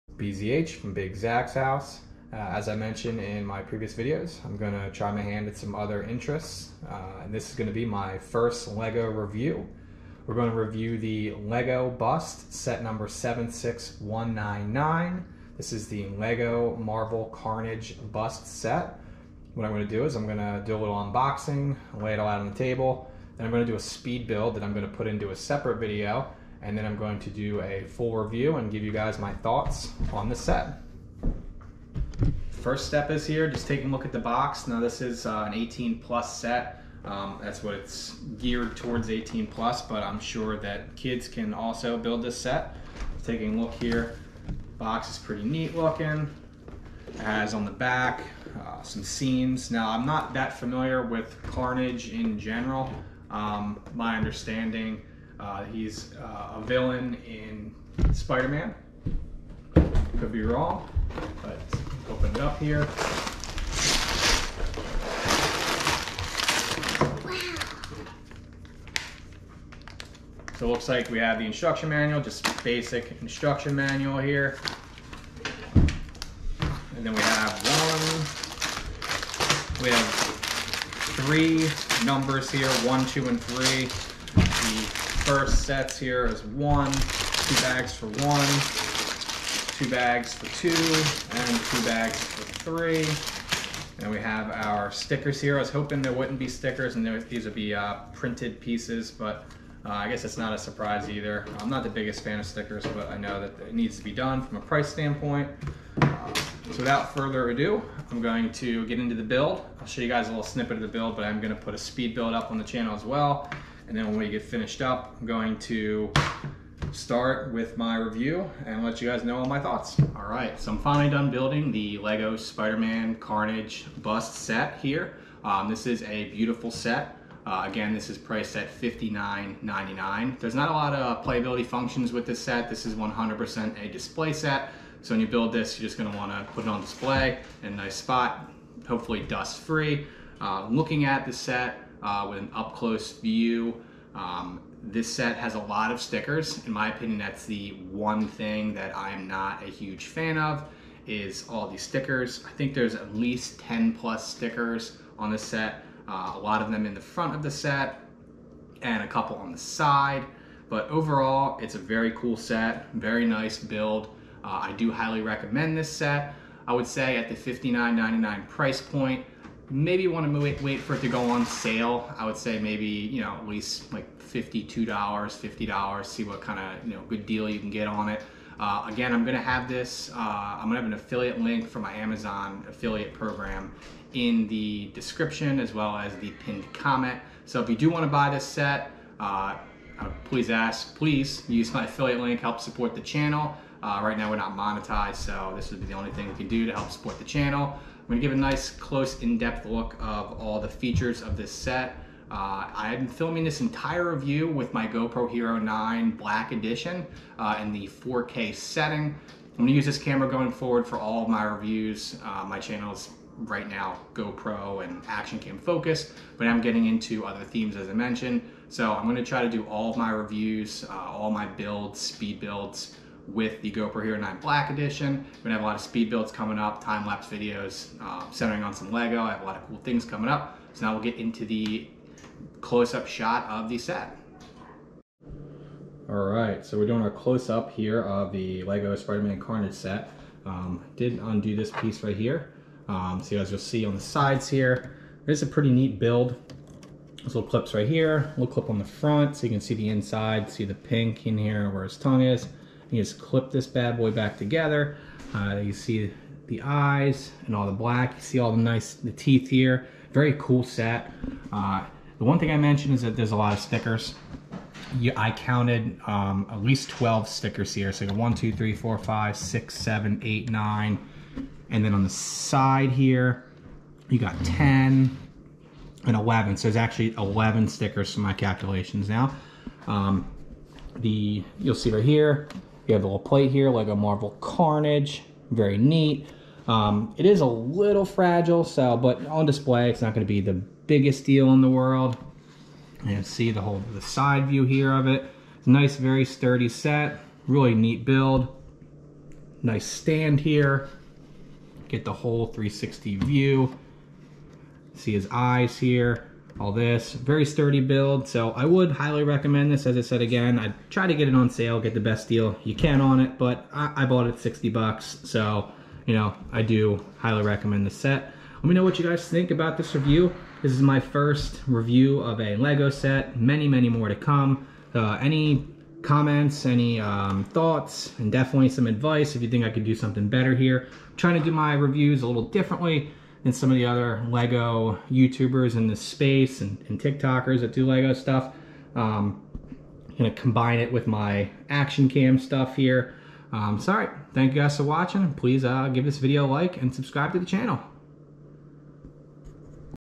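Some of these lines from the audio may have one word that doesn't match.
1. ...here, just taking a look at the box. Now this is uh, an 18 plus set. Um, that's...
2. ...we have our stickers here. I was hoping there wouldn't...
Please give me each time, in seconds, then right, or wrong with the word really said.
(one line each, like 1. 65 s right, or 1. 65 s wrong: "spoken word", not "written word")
1. 33 s right
2. 94 s right.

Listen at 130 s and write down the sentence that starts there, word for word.
There's not a lot of playability functions with this set.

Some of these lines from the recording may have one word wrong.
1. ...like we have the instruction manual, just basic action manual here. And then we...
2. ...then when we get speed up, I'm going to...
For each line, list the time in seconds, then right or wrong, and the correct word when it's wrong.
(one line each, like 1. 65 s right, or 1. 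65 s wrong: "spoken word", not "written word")
1. 70 s wrong: "instruction", not "action"
2. 113 s wrong: "finished", not "speed".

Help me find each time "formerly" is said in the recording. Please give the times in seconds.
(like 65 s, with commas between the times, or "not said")
not said.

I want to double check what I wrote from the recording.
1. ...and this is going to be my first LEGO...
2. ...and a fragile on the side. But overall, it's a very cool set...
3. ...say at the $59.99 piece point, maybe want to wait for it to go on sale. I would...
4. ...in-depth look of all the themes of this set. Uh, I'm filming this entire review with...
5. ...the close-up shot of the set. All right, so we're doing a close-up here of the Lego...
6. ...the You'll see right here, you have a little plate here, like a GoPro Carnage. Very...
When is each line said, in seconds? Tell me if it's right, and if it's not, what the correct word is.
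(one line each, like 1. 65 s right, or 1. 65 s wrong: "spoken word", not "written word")
1. 7 s right
2. 158 s wrong: "couple", not "fragile"
3. 166 s wrong: "price", not "piece"
4. 199 s wrong: "features", not "themes"
5. 231 s right
6. 280 s wrong: "Marvel", not "GoPro".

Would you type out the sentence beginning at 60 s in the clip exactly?
Could be wrong, but open it up here.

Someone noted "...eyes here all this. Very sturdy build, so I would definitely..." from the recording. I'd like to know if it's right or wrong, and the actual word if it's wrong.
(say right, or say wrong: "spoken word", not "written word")
wrong: "highly", not "definitely".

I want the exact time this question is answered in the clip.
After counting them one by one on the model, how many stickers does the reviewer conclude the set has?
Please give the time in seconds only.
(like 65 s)
277 s.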